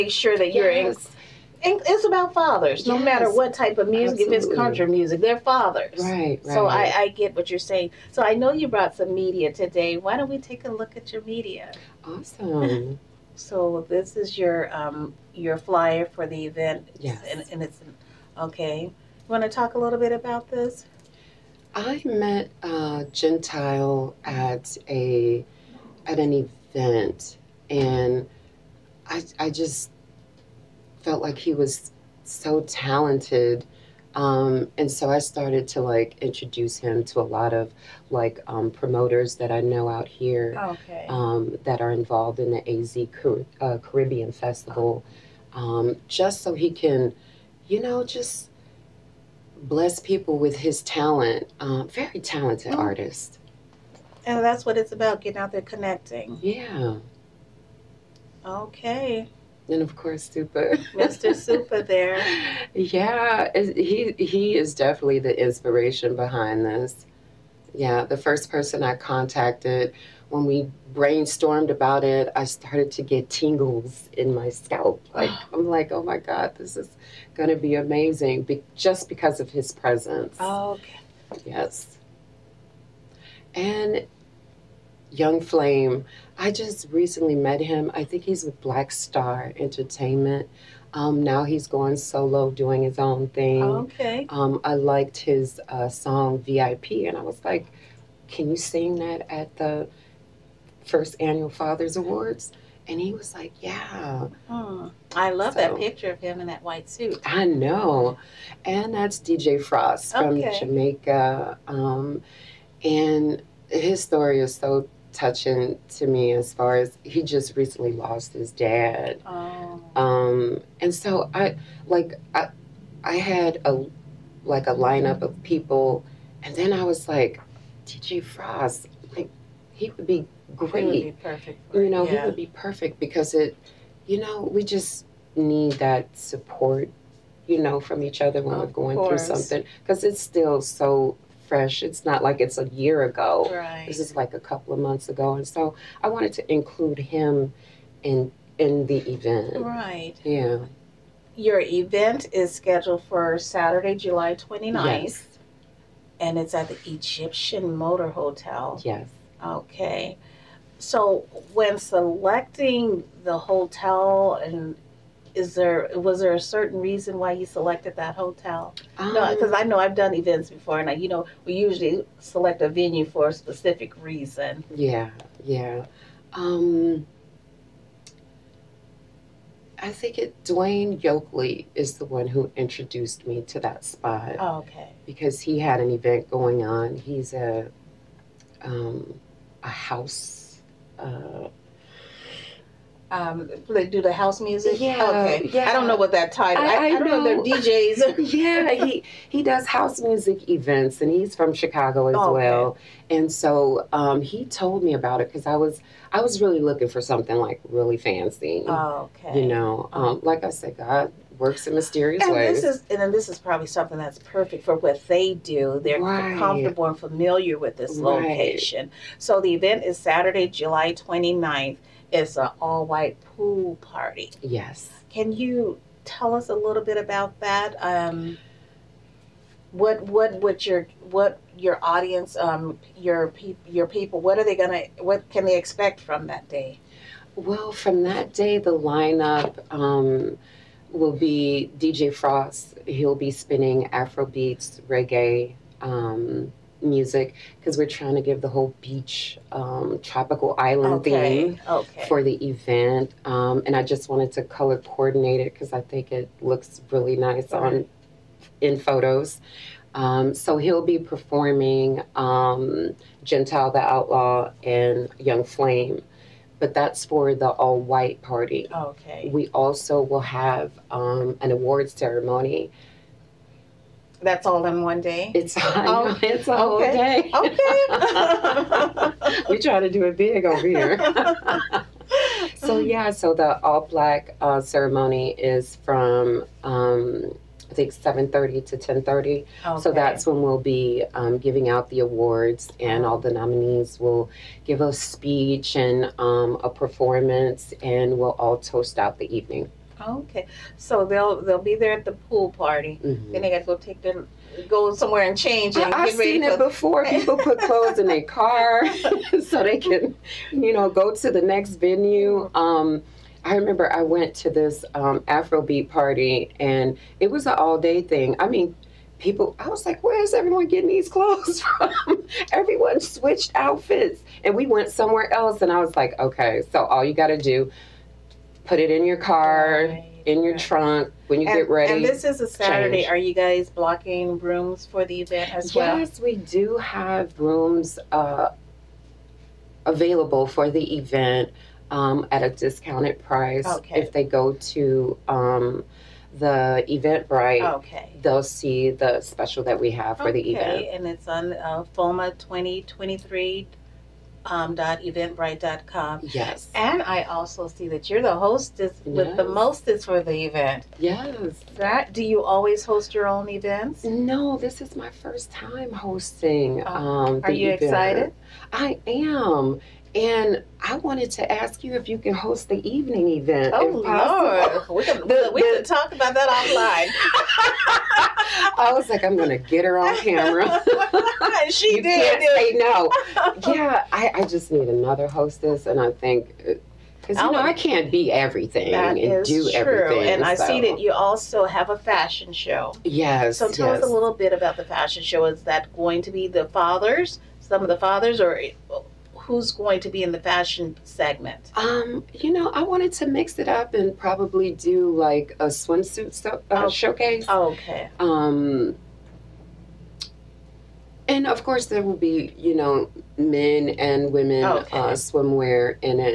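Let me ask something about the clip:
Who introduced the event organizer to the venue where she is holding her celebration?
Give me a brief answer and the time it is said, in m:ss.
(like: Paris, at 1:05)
Dwayne Yokely, at 3:00.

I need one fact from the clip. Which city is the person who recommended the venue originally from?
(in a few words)
Chicago.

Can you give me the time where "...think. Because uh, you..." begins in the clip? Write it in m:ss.
6:26.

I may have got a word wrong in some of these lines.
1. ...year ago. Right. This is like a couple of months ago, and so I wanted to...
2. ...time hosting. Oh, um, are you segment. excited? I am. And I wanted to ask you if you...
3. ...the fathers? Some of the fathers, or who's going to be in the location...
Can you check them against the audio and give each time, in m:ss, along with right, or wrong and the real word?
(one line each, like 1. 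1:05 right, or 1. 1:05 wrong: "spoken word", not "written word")
1. 2:22 right
2. 6:05 wrong: "event", not "segment"
3. 6:36 wrong: "fashion", not "location".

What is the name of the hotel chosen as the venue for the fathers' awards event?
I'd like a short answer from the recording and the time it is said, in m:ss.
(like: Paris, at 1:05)
Egyptian Motor Hotel, at 2:36.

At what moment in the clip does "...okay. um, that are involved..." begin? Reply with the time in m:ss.
0:40.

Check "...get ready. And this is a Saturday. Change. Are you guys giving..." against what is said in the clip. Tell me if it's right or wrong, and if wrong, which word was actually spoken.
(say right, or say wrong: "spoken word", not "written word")
wrong: "blocking", not "giving".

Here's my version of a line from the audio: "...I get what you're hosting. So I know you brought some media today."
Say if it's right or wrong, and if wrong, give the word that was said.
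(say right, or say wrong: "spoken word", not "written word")
wrong: "saying", not "hosting".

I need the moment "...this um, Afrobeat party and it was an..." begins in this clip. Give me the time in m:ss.
5:14.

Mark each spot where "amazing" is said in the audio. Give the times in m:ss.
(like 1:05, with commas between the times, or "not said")
1:17.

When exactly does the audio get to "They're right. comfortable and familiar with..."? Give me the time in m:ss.
3:35.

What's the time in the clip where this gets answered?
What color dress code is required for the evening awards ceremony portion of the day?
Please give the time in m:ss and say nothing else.
4:43.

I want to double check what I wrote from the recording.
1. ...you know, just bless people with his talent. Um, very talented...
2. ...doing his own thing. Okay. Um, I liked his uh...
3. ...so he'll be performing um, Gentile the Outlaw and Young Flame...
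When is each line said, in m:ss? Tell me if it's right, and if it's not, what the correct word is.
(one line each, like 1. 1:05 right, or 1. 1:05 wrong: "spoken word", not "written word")
1. 0:47 right
2. 1:32 right
3. 4:20 right.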